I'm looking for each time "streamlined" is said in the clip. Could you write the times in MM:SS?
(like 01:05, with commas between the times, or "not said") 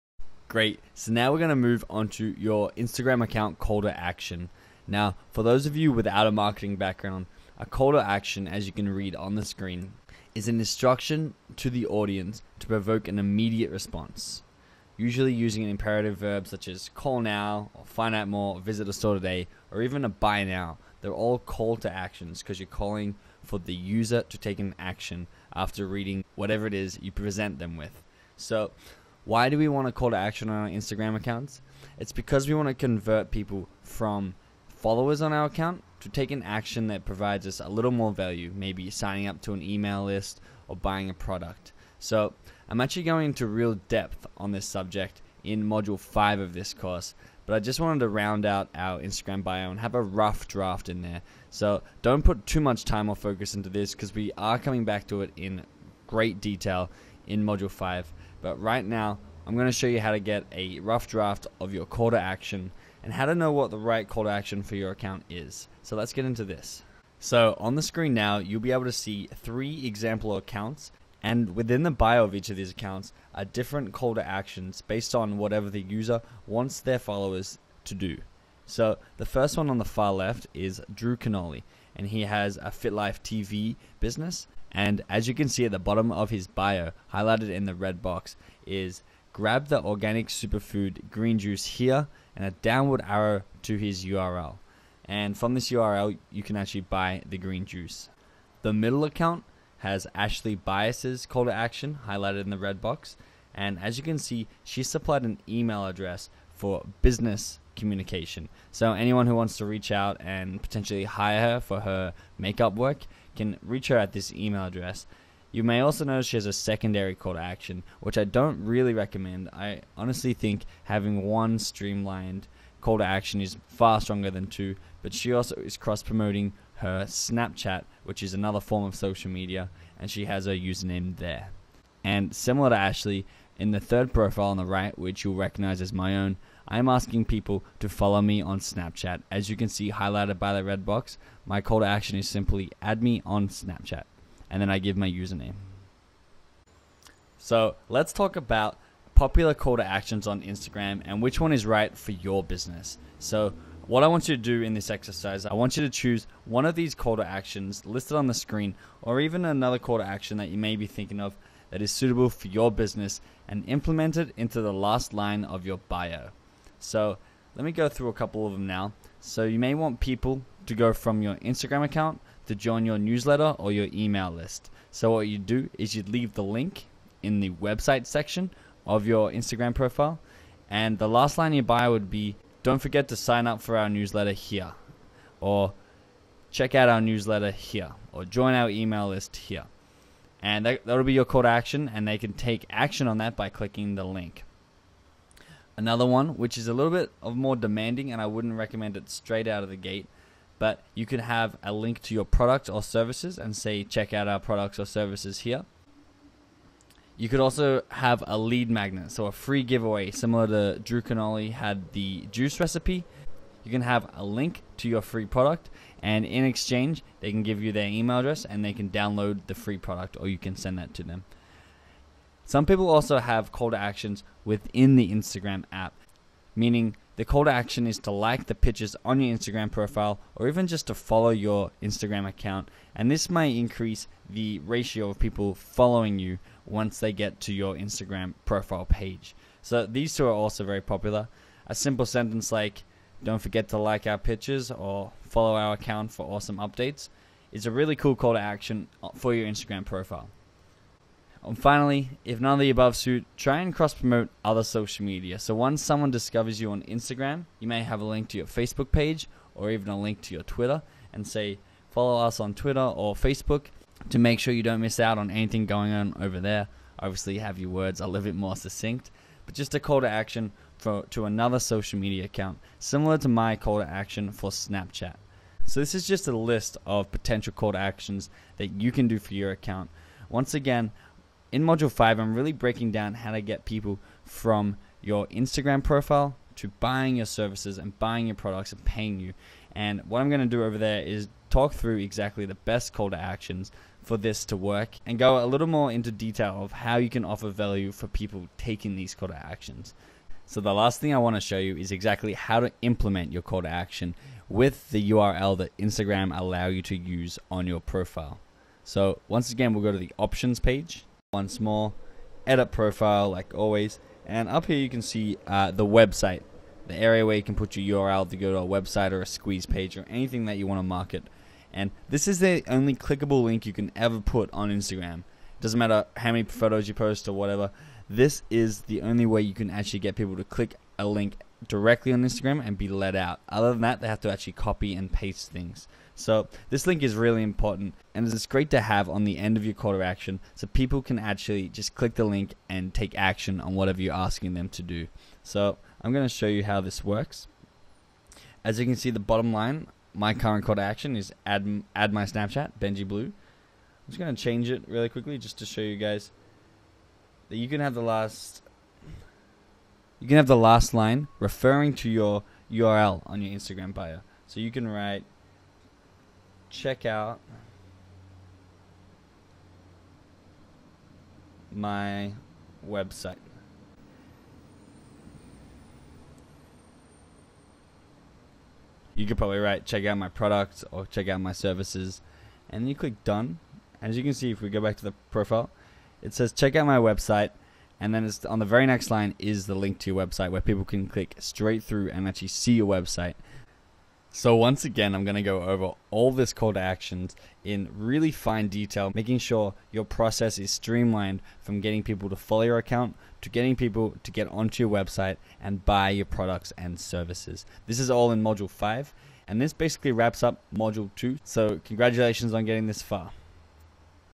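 02:01, 06:40.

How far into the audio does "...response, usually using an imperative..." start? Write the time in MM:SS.
00:13.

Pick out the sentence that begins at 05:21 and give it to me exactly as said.
And this is the only clickable link you can ever put on Instagram.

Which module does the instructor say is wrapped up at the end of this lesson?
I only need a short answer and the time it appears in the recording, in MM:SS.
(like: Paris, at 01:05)
Module 2, at 06:50.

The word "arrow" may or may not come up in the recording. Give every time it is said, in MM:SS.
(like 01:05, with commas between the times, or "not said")
01:33.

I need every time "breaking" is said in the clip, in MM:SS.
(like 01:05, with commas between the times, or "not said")
04:42.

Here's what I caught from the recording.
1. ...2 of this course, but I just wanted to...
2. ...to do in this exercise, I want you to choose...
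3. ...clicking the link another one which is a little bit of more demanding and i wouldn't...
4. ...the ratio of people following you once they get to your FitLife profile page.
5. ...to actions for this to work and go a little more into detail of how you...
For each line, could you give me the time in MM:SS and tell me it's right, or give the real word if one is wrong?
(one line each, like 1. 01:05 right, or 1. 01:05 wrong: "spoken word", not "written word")
1. 00:45 wrong: "5", not "2"
2. 02:34 right
3. 03:13 right
4. 03:54 wrong: "Instagram", not "FitLife"
5. 04:53 right.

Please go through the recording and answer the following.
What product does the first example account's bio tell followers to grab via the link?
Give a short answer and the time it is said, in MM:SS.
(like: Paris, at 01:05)
organic superfood green juice, at 01:29.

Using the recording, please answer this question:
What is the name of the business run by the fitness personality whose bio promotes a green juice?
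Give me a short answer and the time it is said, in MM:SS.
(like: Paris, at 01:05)
FitLife TV, at 01:22.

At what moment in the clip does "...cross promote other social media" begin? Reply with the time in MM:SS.
04:13.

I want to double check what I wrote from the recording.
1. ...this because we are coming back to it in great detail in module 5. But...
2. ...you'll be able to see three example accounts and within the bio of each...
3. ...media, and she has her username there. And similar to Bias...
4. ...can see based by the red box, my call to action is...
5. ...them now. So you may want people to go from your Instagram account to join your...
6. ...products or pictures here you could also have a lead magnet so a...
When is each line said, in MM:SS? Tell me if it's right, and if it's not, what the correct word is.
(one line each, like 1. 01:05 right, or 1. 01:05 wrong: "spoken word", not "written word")
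1. 00:53 right
2. 01:08 right
3. 02:09 wrong: "Ashley", not "Bias"
4. 02:19 wrong: "highlighted", not "based"
5. 02:48 right
6. 03:24 wrong: "services", not "pictures".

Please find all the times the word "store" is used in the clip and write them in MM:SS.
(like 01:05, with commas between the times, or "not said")
00:18.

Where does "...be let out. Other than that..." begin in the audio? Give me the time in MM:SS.
05:32.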